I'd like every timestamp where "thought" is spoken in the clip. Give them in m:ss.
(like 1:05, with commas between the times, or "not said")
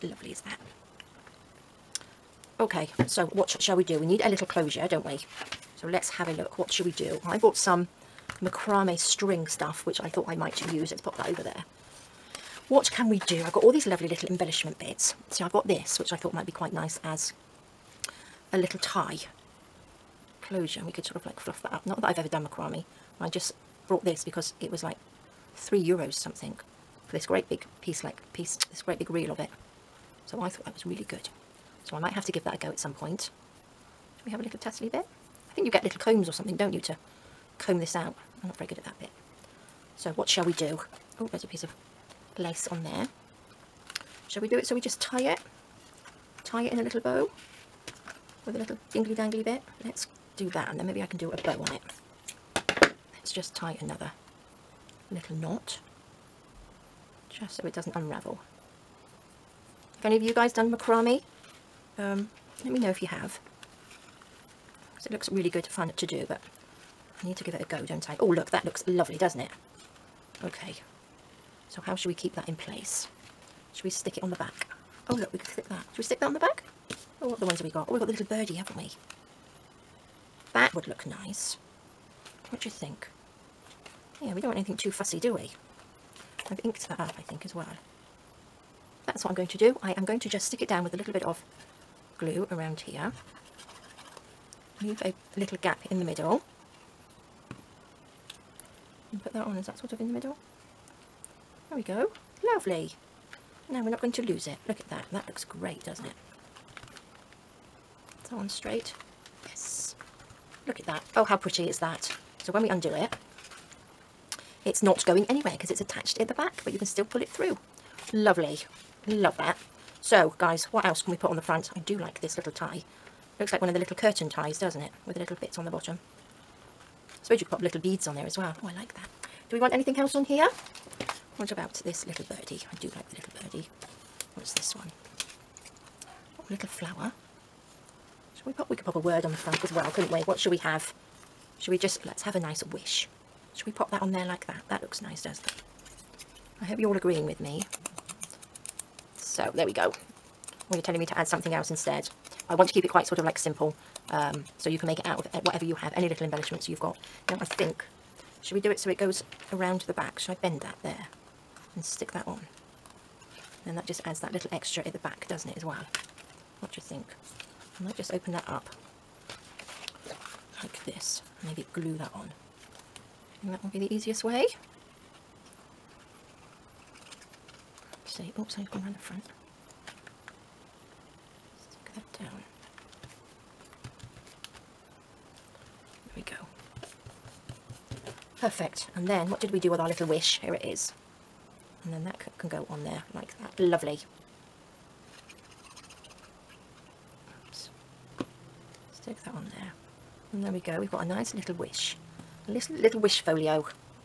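0:10, 0:16, 0:30.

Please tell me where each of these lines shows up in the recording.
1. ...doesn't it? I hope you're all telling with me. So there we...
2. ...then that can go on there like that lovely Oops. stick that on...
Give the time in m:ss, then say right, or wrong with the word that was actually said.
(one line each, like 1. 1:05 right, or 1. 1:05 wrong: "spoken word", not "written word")
1. 2:25 wrong: "agreeing", not "telling"
2. 3:11 right.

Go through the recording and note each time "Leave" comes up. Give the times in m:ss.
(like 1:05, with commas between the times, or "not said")
1:34.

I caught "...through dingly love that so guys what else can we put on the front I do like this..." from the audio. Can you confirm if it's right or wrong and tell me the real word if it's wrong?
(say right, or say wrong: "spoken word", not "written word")
wrong: "lovely", not "dingly".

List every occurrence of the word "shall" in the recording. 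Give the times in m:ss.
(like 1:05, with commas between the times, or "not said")
0:03, 0:34, 0:40, 0:44.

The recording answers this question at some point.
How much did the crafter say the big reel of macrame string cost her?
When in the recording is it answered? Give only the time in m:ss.
0:25.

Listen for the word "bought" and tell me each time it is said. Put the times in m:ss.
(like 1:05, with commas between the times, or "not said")
0:07.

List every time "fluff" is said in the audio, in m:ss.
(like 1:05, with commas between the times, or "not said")
0:21.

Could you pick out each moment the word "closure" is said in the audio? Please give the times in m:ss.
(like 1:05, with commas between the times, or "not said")
0:04, 0:20.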